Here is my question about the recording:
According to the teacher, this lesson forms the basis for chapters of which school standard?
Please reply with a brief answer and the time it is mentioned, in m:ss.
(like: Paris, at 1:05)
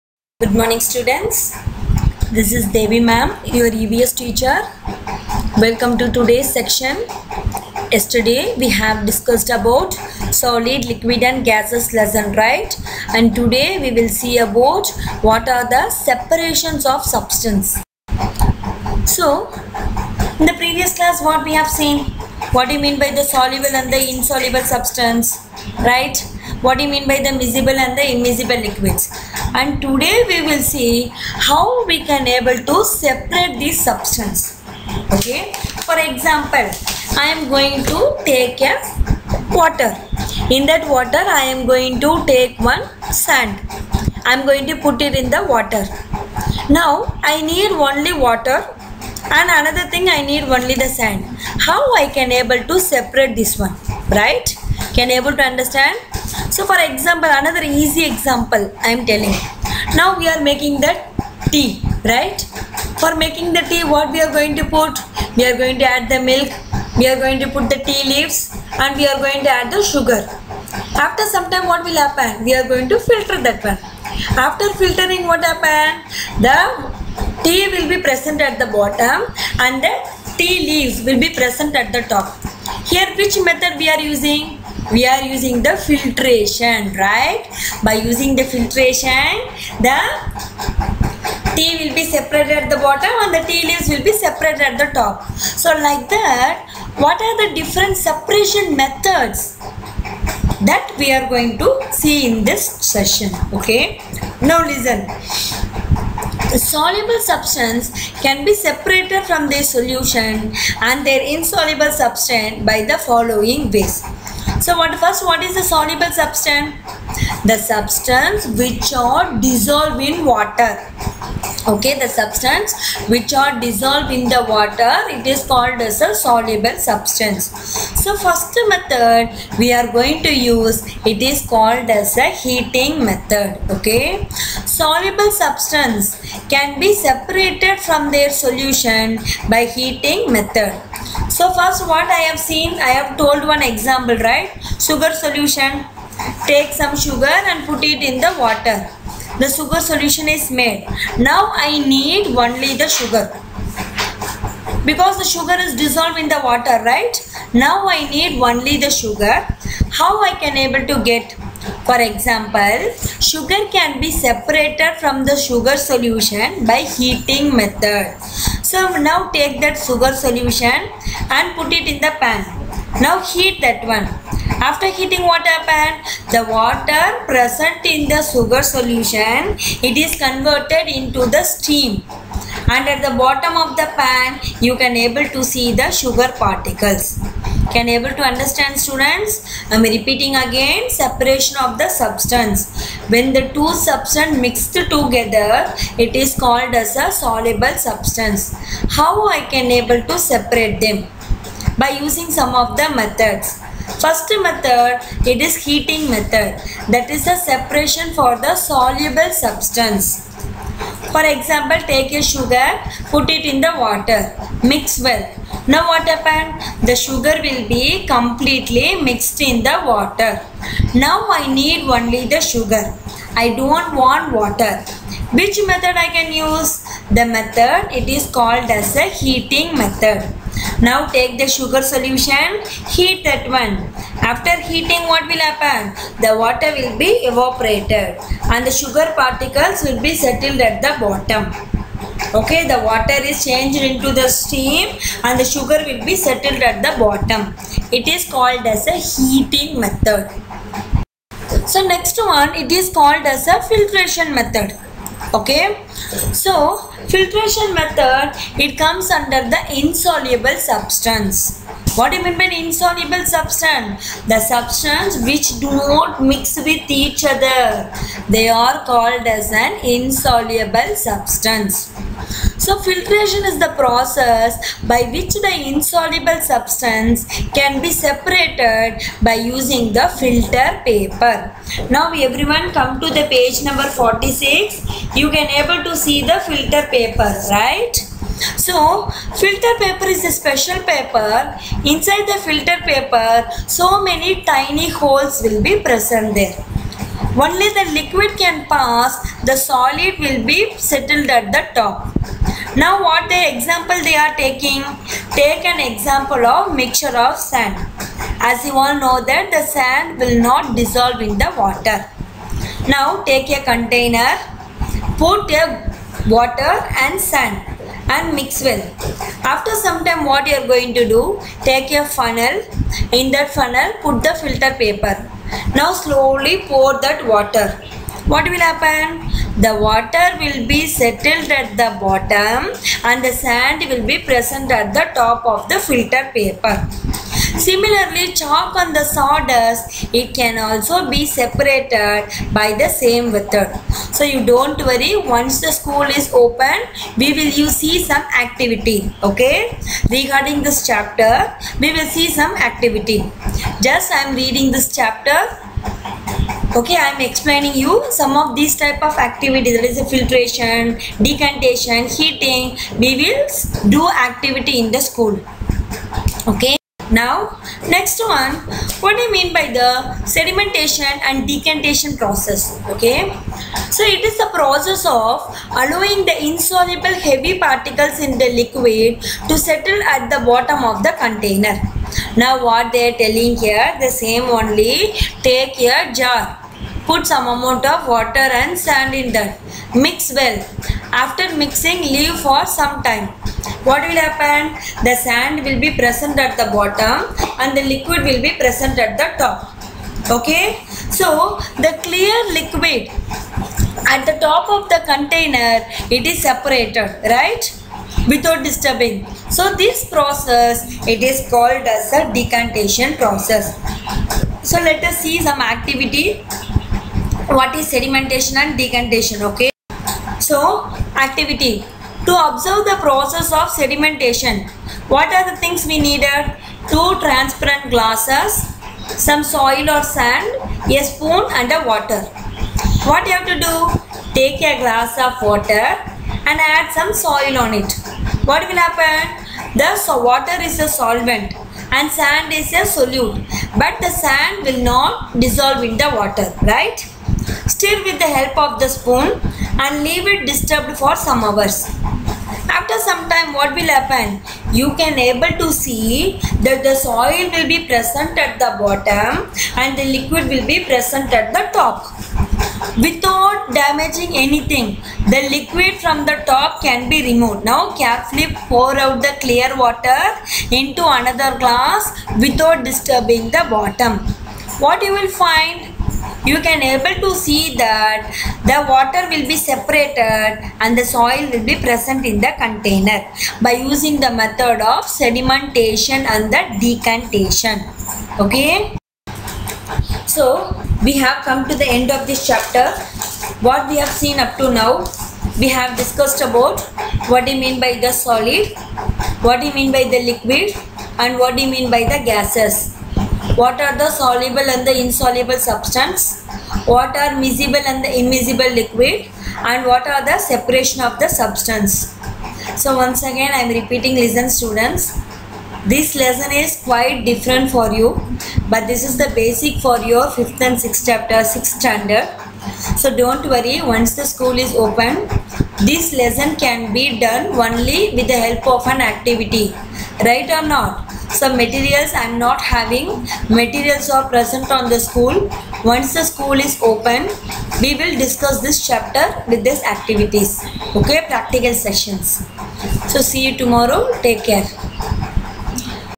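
6th standard, at 8:41.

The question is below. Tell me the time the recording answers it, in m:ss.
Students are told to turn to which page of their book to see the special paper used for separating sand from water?
4:43.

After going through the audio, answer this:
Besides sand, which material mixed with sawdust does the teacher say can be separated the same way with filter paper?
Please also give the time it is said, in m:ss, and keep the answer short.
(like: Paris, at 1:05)
Chalk, at 5:38.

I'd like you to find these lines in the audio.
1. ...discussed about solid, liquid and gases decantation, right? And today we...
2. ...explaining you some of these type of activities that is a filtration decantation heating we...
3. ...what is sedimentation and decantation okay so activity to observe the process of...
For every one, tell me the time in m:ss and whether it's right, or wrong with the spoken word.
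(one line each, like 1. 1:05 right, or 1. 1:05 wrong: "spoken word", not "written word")
1. 0:09 wrong: "lesson", not "decantation"
2. 5:57 right
3. 6:57 right.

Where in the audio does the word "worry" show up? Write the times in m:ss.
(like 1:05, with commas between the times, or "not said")
5:44, 8:43.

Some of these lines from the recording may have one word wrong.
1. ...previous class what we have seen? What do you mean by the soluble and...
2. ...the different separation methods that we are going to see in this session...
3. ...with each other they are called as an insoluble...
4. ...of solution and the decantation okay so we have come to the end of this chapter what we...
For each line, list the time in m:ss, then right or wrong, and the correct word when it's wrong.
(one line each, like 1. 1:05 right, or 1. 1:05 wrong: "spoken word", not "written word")
1. 0:20 right
2. 1:37 right
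3. 4:26 right
4. 8:04 wrong: "sedimentation", not "solution".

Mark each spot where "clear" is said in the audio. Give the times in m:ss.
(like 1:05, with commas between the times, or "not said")
6:42, 7:49.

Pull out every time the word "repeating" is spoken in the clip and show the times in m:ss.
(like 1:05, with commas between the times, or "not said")
3:09, 8:33.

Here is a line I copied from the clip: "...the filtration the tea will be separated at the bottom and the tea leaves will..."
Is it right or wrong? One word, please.
right.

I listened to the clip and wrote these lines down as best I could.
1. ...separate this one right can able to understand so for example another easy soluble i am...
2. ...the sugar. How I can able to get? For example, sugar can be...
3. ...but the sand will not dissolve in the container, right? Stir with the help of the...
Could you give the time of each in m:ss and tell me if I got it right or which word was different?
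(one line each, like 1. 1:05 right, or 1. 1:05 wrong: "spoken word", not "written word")
1. 0:52 wrong: "example", not "soluble"
2. 2:38 right
3. 7:23 wrong: "water", not "container".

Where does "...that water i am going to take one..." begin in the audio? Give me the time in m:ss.
0:40.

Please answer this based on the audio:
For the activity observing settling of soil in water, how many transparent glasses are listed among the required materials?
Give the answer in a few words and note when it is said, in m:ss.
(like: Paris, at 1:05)
2, at 7:06.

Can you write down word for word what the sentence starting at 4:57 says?
Only the liquid can pass, the solid will be settled at the top.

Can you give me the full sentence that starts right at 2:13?
Okay, soluble substance can be separated from their solution by heating method.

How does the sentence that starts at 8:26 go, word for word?
What are miscible and the immiscible liquid?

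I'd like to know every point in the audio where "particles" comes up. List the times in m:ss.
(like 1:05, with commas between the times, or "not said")
3:06, 3:59, 6:17.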